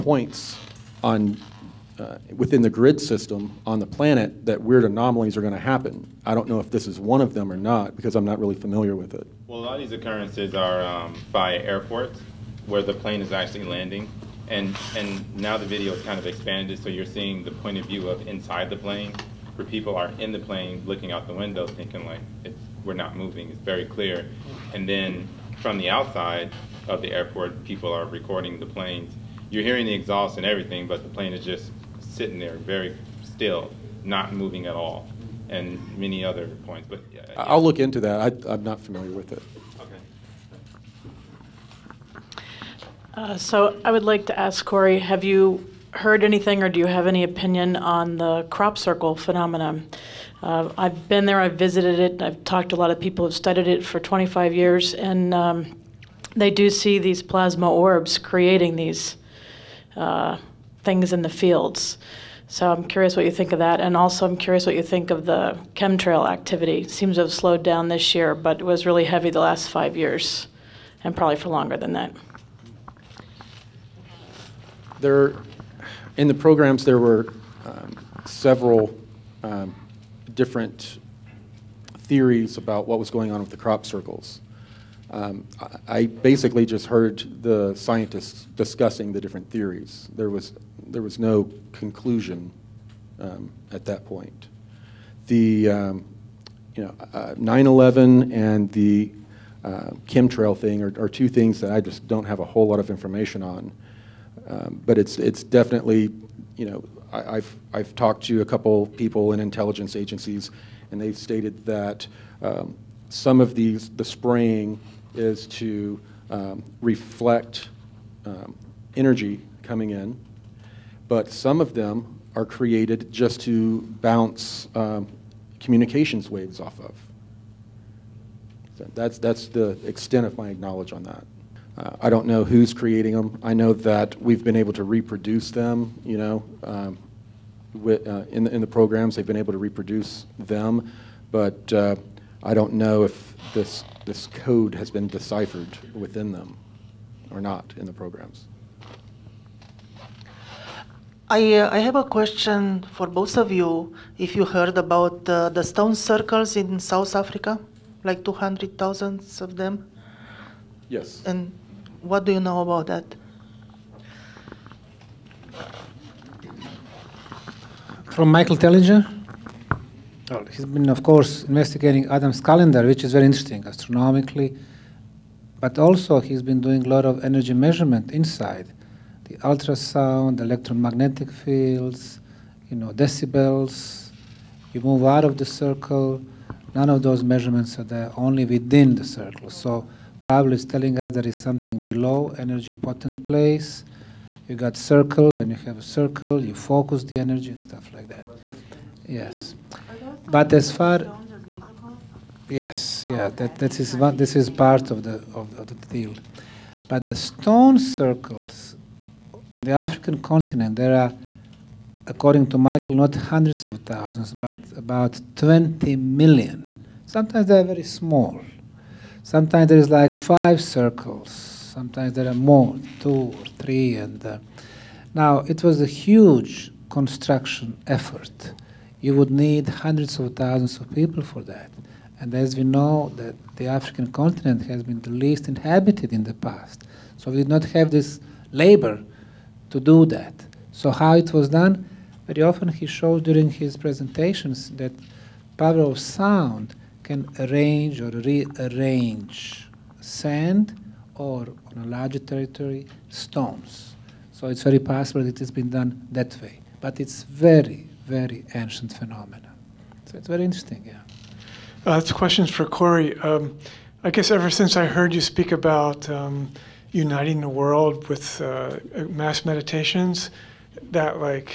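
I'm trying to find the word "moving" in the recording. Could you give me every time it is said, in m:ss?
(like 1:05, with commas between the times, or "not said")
0:23, 0:34.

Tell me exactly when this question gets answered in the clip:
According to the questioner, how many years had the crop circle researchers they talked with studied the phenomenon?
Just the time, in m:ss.
0:53.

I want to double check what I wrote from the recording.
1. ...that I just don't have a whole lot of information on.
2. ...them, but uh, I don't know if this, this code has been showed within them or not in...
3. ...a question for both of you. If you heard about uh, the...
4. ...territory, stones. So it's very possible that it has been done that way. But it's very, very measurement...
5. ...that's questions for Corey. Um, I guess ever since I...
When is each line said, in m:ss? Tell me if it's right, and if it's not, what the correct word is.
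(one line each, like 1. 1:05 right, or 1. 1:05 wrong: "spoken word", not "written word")
1. 1:41 right
2. 2:20 wrong: "deciphered", not "showed"
3. 2:31 right
4. 4:12 wrong: "ancient", not "measurement"
5. 4:21 right.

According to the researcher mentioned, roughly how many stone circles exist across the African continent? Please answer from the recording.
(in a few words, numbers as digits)
20 million.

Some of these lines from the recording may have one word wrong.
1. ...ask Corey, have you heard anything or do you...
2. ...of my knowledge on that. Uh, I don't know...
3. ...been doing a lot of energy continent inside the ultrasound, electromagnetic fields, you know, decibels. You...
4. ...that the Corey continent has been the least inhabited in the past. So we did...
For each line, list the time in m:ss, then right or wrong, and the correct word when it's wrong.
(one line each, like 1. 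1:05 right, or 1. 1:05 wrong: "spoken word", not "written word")
1. 0:44 right
2. 2:10 right
3. 2:56 wrong: "measurement", not "continent"
4. 3:53 wrong: "African", not "Corey".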